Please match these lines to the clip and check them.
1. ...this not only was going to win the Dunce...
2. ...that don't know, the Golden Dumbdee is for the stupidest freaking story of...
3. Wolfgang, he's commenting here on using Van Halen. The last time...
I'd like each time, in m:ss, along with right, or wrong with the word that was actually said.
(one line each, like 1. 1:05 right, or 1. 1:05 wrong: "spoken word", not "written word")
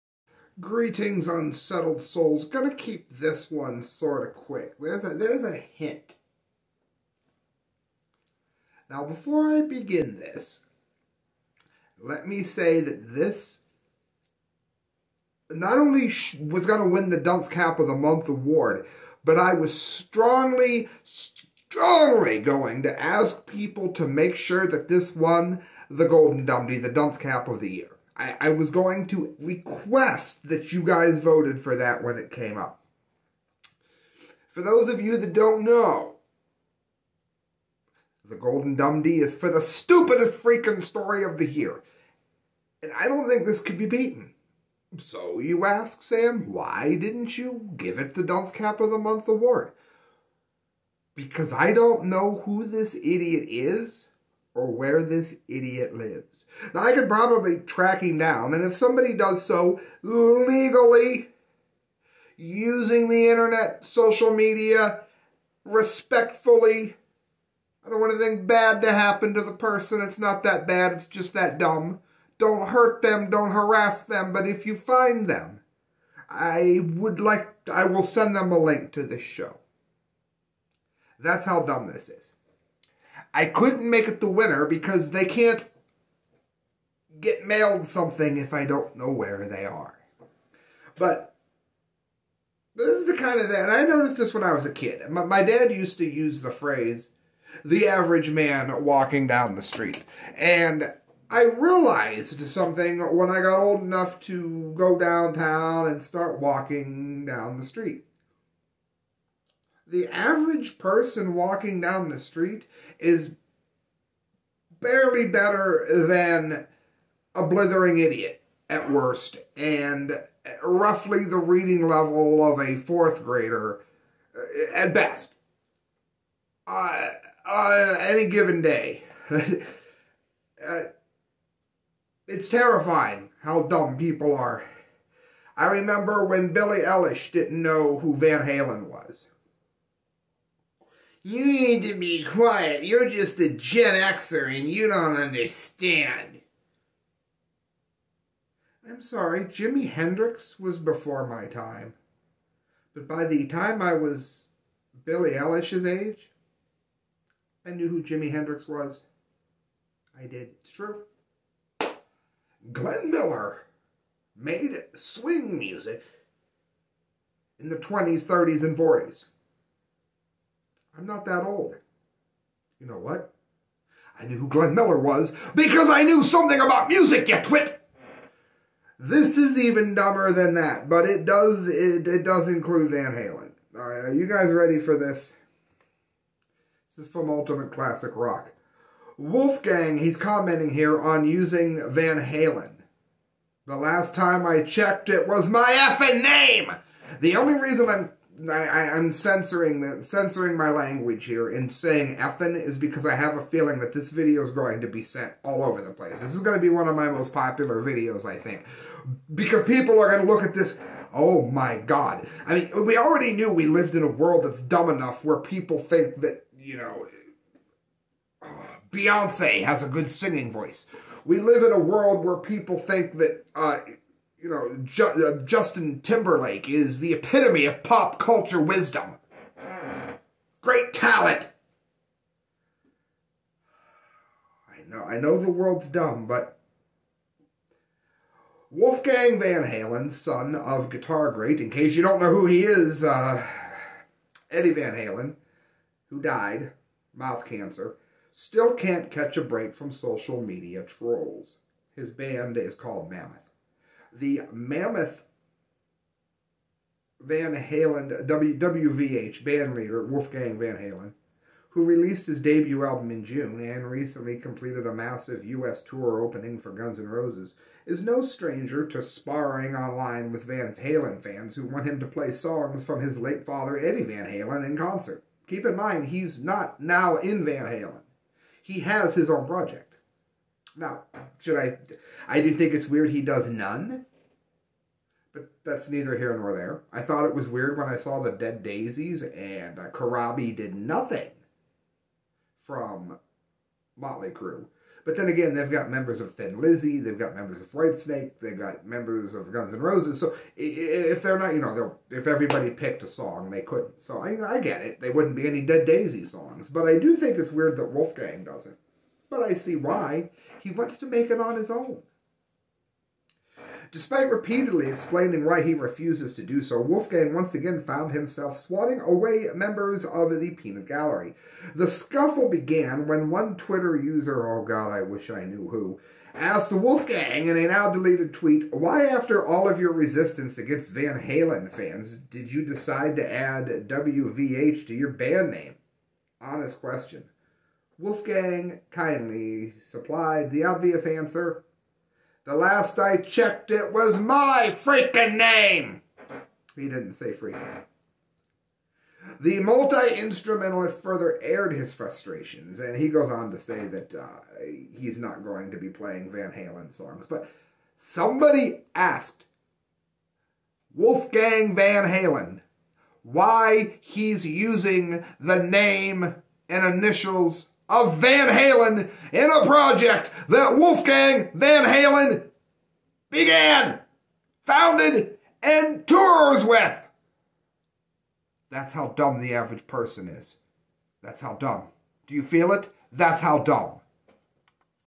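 1. 0:13 right
2. 0:35 right
3. 3:09 right.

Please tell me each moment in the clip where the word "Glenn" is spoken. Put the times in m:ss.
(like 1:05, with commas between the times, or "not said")
2:42, 2:54.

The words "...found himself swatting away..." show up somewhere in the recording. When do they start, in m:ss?
5:17.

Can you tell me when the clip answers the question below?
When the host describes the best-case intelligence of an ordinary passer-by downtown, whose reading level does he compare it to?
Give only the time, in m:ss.
2:02.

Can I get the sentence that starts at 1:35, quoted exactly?
My, my dad used to use the phrase, the average man walking down the street.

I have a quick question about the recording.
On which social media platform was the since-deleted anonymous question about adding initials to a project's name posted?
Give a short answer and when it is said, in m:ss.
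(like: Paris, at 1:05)
Twitter, at 5:23.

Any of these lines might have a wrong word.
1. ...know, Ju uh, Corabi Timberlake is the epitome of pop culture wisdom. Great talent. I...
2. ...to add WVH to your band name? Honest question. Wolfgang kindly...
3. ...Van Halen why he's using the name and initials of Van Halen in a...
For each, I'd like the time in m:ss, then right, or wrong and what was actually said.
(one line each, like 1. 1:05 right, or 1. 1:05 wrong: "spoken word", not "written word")
1. 3:44 wrong: "Justin", not "Corabi"
2. 5:33 right
3. 6:01 right.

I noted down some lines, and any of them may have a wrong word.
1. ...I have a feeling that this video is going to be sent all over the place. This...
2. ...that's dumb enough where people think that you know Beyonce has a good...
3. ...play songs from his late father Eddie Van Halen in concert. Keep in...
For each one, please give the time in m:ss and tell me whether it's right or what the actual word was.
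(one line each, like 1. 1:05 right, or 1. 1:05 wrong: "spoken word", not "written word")
1. 3:23 right
2. 3:34 right
3. 4:32 right.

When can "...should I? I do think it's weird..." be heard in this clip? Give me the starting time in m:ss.
4:41.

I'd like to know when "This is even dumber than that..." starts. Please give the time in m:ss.
2:58.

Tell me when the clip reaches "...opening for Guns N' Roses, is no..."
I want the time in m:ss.
4:26.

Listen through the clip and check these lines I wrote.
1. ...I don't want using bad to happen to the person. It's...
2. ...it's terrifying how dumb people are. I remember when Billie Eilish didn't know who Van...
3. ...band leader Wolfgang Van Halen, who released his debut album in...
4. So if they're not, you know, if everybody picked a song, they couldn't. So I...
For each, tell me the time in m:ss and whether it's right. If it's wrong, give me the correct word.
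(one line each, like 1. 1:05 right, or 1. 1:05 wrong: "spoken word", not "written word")
1. 1:07 wrong: "anything", not "using"
2. 2:12 right
3. 4:19 right
4. 5:00 right.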